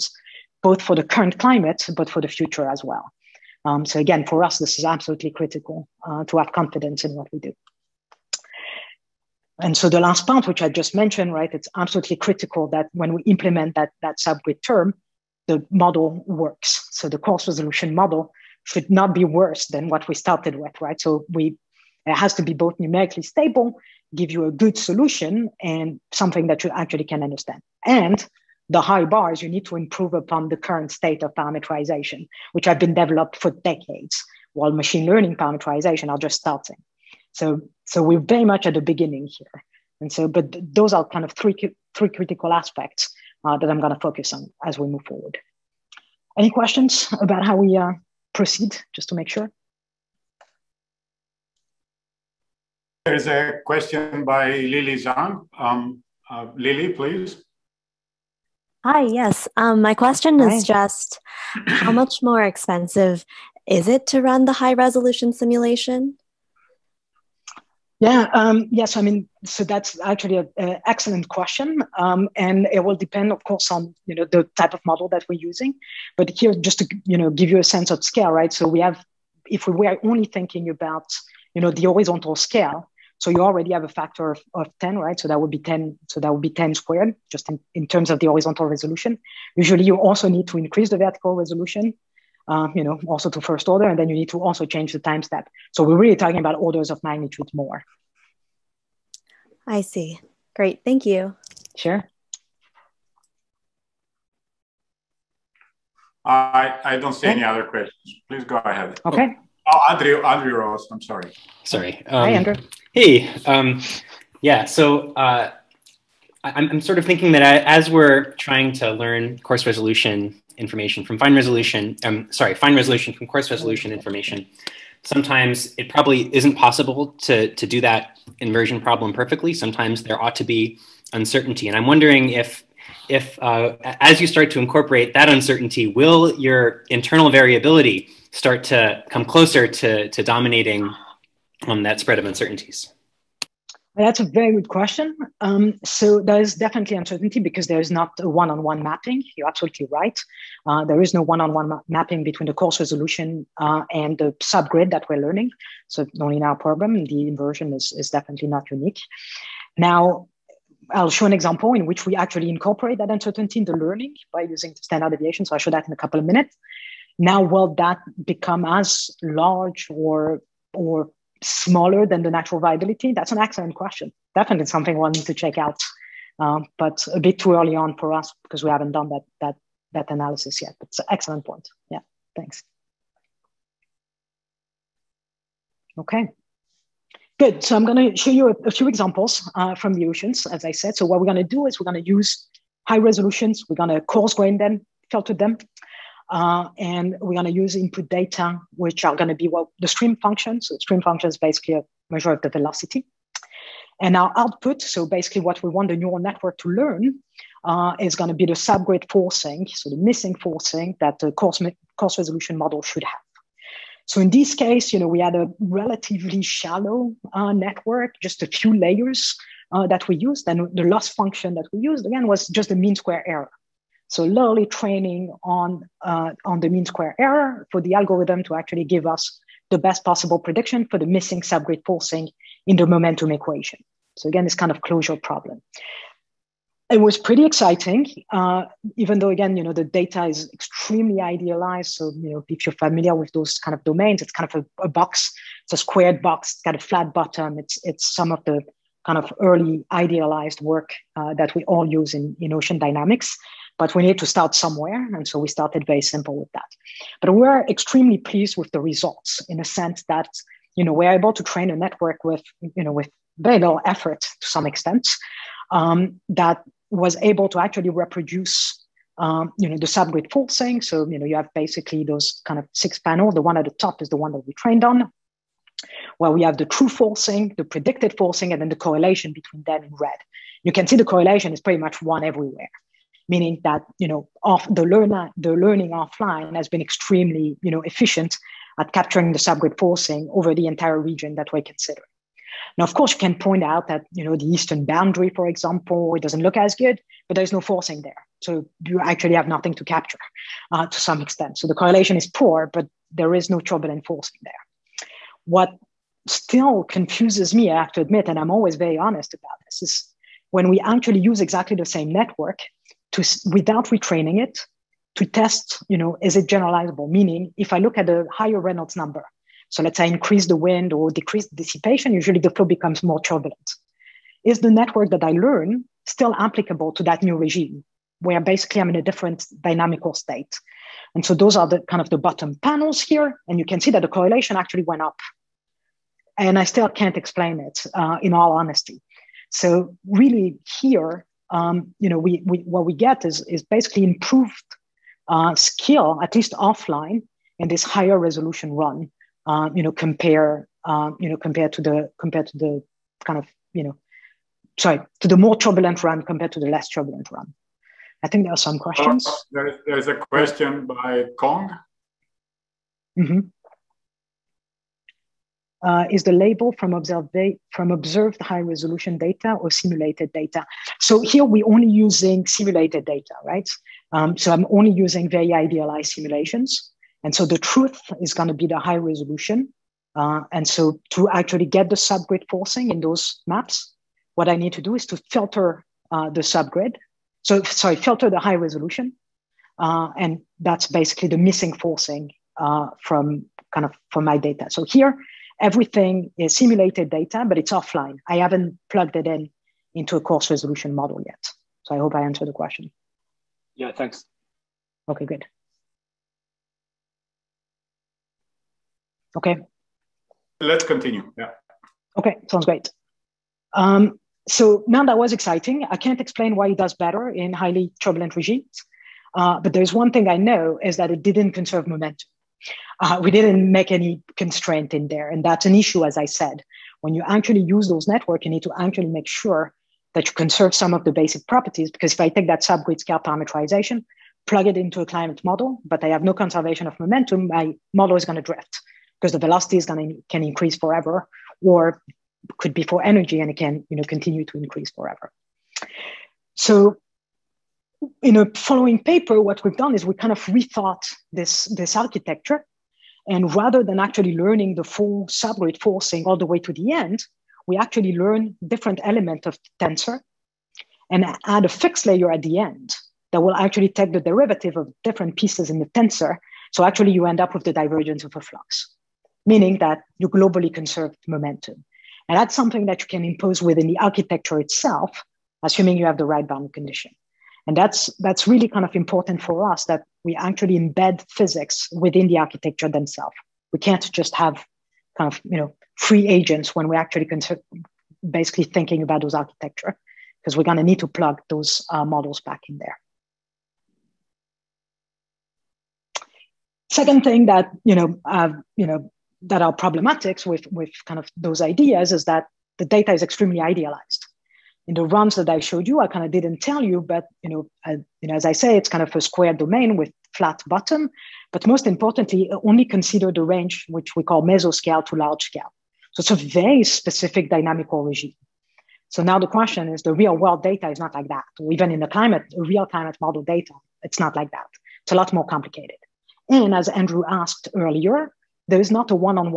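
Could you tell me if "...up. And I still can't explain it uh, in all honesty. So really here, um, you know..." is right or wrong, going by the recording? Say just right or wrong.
right.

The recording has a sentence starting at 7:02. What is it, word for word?
Uh, we didn't make any constraint in there.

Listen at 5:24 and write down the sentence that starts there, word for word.
Is the network that I learn still applicable to that new regime where basically I'm in a different dynamical state?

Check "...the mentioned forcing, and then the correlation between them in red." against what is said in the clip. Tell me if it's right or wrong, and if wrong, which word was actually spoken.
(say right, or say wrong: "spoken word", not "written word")
wrong: "predicted", not "mentioned".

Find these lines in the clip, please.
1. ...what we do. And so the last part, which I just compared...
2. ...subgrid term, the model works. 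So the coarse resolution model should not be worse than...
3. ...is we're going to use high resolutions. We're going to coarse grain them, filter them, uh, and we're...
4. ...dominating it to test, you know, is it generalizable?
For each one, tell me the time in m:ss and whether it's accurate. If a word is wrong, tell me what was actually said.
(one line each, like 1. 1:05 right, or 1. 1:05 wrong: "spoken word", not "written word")
1. 0:07 wrong: "mentioned", not "compared"
2. 0:14 right
3. 3:11 right
4. 5:13 wrong: "retraining", not "dominating".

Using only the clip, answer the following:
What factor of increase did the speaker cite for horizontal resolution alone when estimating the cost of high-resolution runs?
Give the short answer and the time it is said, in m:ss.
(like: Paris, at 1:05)
10 squared, at 1:26.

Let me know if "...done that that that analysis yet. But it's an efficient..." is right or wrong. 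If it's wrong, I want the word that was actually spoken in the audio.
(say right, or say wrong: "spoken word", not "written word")
wrong: "excellent", not "efficient".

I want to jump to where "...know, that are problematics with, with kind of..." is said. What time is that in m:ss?
8:18.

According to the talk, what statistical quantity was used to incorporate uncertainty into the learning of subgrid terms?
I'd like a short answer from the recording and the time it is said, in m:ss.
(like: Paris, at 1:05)
standard deviation, at 2:44.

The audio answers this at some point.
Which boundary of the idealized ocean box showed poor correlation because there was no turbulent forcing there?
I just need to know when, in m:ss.
4:54.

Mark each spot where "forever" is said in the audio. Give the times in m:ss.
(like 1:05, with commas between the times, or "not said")
7:20, 7:24.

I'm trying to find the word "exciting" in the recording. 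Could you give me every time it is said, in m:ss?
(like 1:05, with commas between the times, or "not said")
3:57, 6:55.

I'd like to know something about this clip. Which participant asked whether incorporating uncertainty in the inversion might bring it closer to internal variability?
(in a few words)
Andrew Ross.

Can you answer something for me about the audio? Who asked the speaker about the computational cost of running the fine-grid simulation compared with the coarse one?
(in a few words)
Lily Zhang.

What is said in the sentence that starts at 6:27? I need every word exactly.
So sorry, filter the high resolution.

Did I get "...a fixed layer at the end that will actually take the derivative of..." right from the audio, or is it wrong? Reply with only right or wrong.
right.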